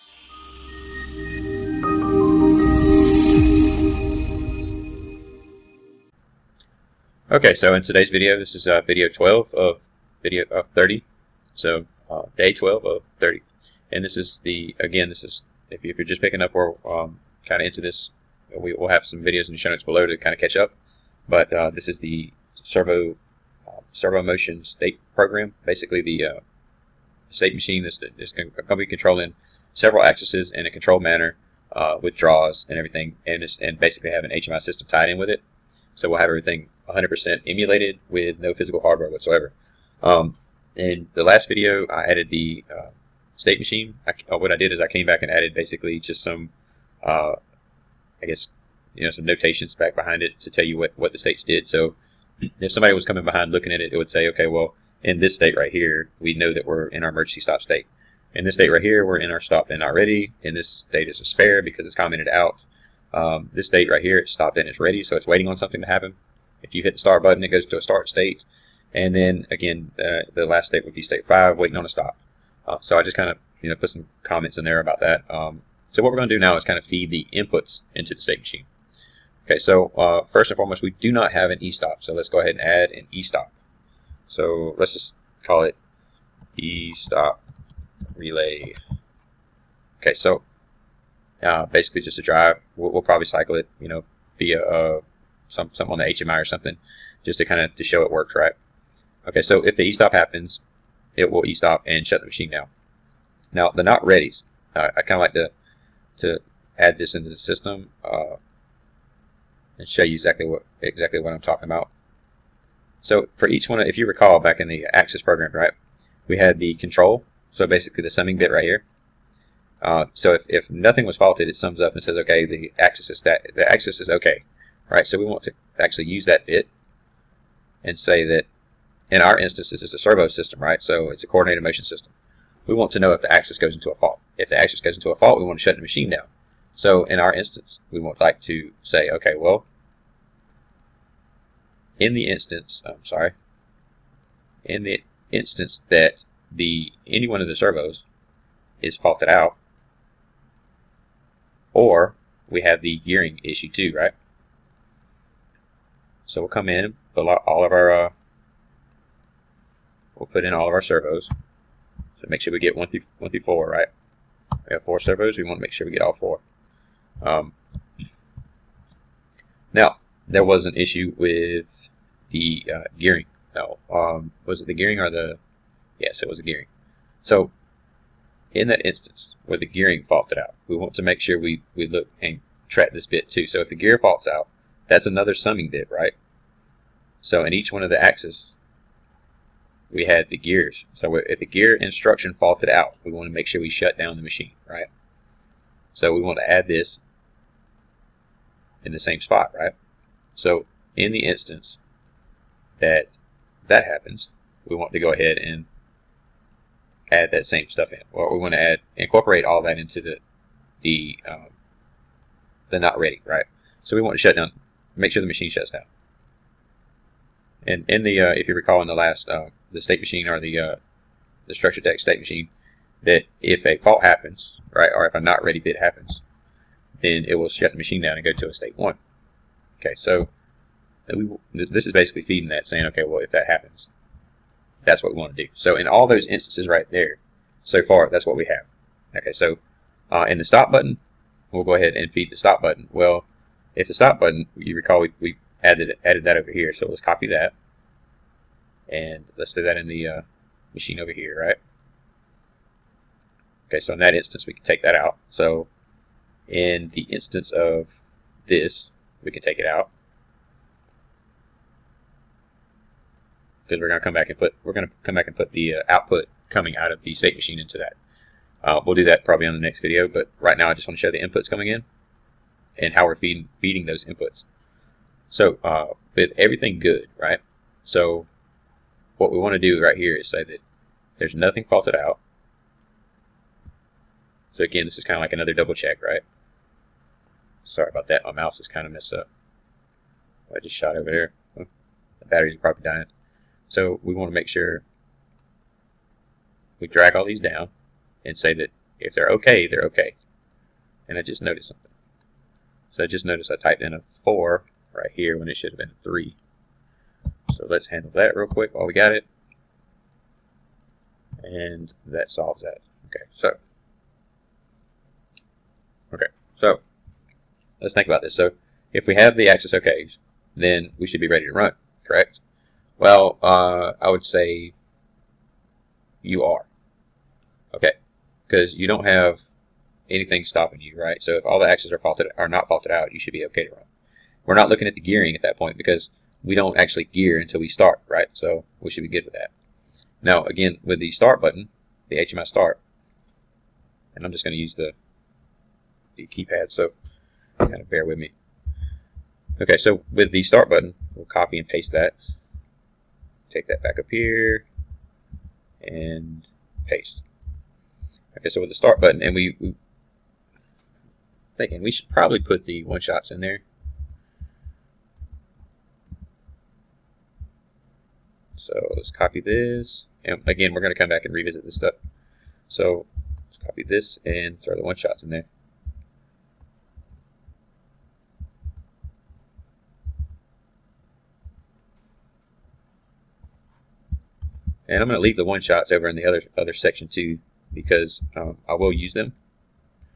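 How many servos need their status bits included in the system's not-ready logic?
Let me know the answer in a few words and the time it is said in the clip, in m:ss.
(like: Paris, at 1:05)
4, at 2:44.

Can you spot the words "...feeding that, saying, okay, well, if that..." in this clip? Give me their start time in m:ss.
3:52.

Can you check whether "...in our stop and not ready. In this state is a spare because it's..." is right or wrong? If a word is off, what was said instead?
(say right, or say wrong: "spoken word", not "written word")
right.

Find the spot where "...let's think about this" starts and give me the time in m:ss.
5:17.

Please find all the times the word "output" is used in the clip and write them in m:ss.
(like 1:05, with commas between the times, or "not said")
4:25.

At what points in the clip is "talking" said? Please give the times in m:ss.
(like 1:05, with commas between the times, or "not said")
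1:51.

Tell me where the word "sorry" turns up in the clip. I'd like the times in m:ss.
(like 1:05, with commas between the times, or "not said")
2:23, 4:47.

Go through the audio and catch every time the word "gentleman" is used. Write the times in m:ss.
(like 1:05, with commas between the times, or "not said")
not said.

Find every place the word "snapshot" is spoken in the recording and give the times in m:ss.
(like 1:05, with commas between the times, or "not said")
not said.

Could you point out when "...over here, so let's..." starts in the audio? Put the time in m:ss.
4:06.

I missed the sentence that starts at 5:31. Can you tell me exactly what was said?
So if all the axes are faulted are not faulted out, you should be okay to run.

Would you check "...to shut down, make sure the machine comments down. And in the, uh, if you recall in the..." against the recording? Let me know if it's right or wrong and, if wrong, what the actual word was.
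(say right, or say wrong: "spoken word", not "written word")
wrong: "shuts", not "comments".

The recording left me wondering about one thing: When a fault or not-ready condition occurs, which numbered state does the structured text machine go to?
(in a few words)
state 1.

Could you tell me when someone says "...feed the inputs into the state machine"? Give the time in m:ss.
1:16.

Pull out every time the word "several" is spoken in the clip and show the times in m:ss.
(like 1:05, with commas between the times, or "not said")
0:29.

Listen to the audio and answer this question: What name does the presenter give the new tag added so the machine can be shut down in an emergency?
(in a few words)
e-stop relay.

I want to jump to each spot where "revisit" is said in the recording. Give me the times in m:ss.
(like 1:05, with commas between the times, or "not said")
6:11.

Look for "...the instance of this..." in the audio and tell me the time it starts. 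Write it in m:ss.
4:16.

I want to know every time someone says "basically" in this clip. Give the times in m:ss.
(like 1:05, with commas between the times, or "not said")
0:25, 0:33, 0:45, 1:31, 1:57, 3:51.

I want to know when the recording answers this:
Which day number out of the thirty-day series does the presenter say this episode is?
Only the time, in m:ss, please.
0:12.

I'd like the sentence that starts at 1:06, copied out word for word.
If you hit the star button, it goes to a start state.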